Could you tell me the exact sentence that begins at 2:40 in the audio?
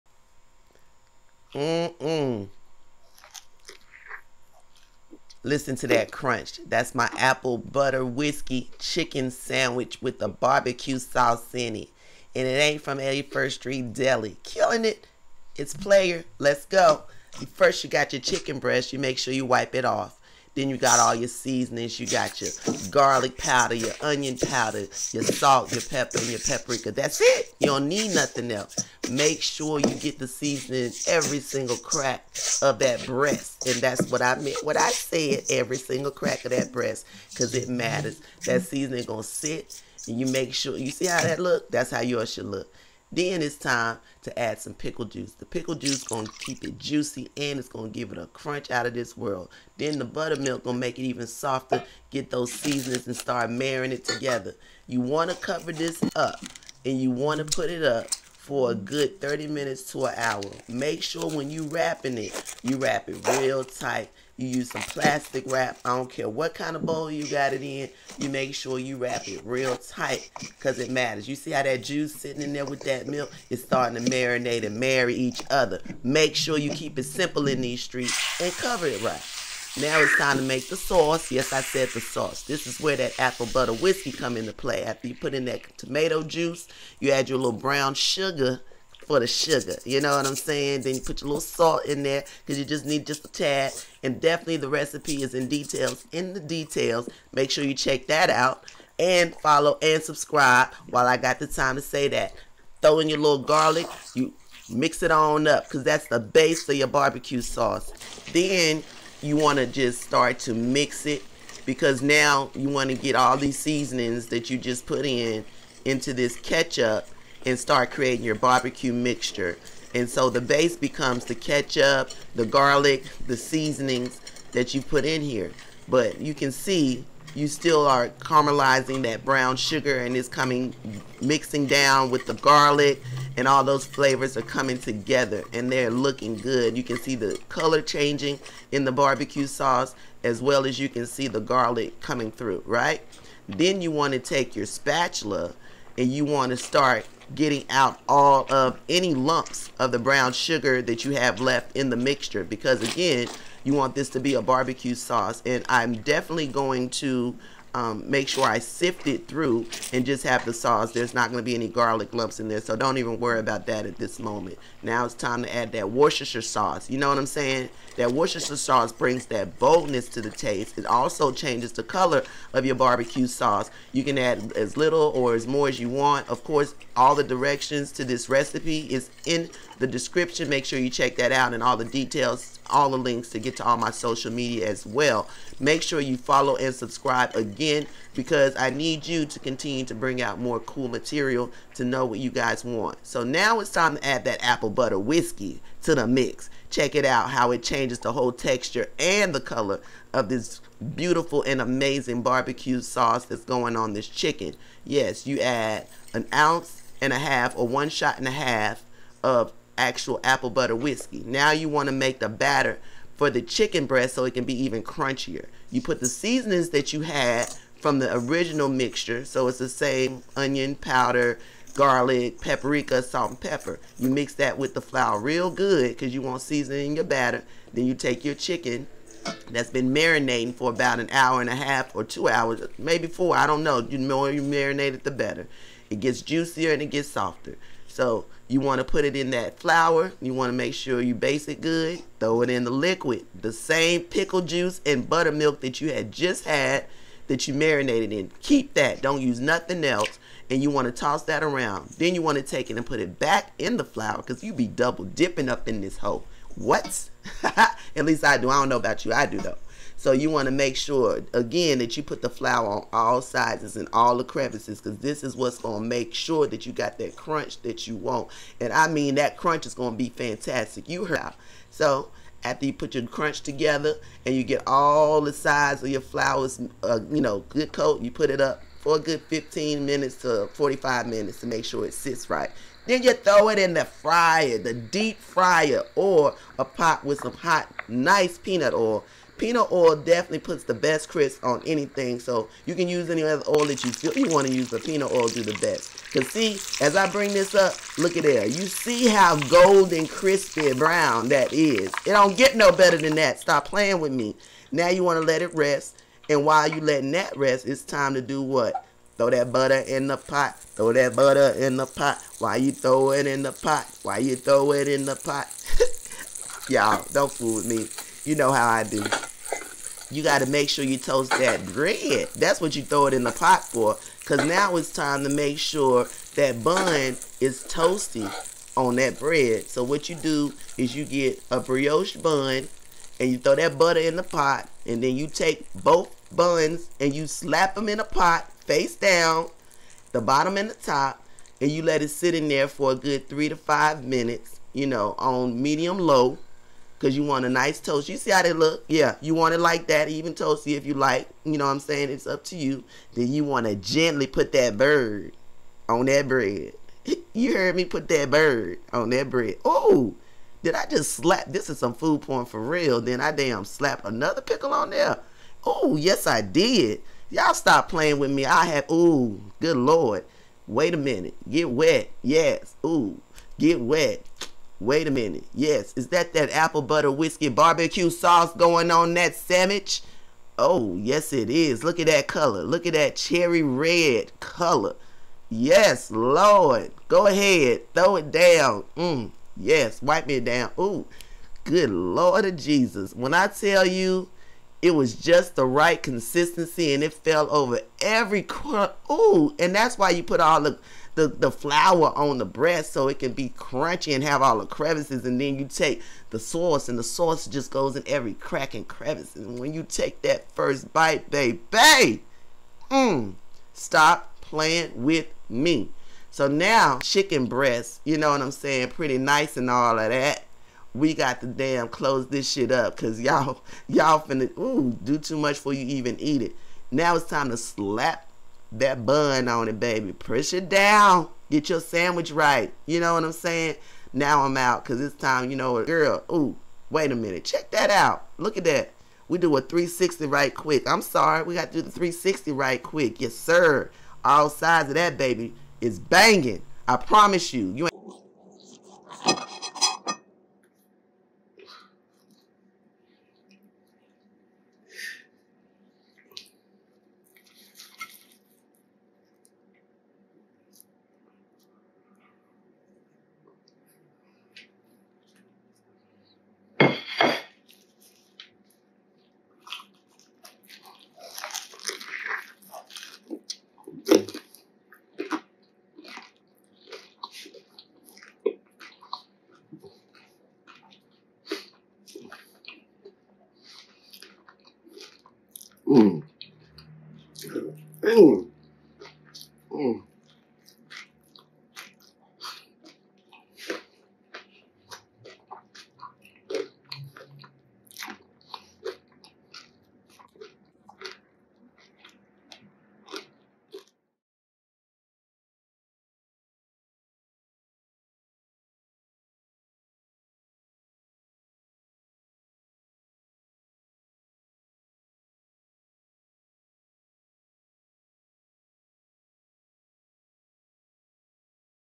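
There's not going to be any garlic lumps in there, so don't even worry about that at this moment.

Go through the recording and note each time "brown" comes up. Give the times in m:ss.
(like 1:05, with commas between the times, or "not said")
1:27, 2:09, 2:29, 5:00.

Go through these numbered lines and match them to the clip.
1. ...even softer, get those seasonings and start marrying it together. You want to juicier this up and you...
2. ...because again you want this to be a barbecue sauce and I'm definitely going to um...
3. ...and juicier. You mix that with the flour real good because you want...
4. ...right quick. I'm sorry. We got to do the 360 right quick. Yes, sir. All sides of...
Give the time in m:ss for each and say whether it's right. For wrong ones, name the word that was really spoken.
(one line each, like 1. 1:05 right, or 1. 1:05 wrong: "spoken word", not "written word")
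1. 0:51 wrong: "cover", not "juicier"
2. 2:32 right
3. 3:43 wrong: "pepper", not "juicier"
4. 7:20 right.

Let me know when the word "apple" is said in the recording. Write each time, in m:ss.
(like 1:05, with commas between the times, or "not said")
0:07, 1:23, 3:14, 3:30, 6:16.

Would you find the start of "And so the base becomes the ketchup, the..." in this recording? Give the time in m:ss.
1:59.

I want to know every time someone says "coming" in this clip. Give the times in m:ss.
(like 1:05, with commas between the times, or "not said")
2:10, 2:14, 2:22.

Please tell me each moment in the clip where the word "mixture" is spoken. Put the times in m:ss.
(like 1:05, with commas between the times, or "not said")
1:58, 2:31, 3:38.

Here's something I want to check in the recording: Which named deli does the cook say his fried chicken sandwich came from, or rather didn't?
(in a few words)
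81st Street Deli.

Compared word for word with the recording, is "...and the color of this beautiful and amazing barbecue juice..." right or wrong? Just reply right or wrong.
wrong.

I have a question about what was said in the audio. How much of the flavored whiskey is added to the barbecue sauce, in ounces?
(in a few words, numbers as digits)
1.5 ounces.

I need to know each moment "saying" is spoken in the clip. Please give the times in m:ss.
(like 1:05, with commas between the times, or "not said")
1:30, 2:47, 5:51, 6:58, 7:13.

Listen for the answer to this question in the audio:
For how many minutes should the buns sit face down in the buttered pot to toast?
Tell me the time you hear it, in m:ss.
5:43.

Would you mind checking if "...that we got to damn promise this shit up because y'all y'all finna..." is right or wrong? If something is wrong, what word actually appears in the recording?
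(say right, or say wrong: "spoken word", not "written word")
wrong: "close", not "promise".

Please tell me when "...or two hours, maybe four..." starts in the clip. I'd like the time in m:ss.
3:51.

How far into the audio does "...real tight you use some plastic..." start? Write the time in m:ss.
1:03.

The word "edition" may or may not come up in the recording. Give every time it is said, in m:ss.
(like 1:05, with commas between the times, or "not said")
not said.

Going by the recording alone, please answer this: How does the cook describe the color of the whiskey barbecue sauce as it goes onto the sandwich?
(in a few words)
cherry red.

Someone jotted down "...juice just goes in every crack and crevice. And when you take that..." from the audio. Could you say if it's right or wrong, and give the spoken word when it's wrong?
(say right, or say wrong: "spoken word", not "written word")
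wrong: "sauce", not "juice".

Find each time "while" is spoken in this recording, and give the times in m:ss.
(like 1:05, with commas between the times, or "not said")
1:40, 5:06.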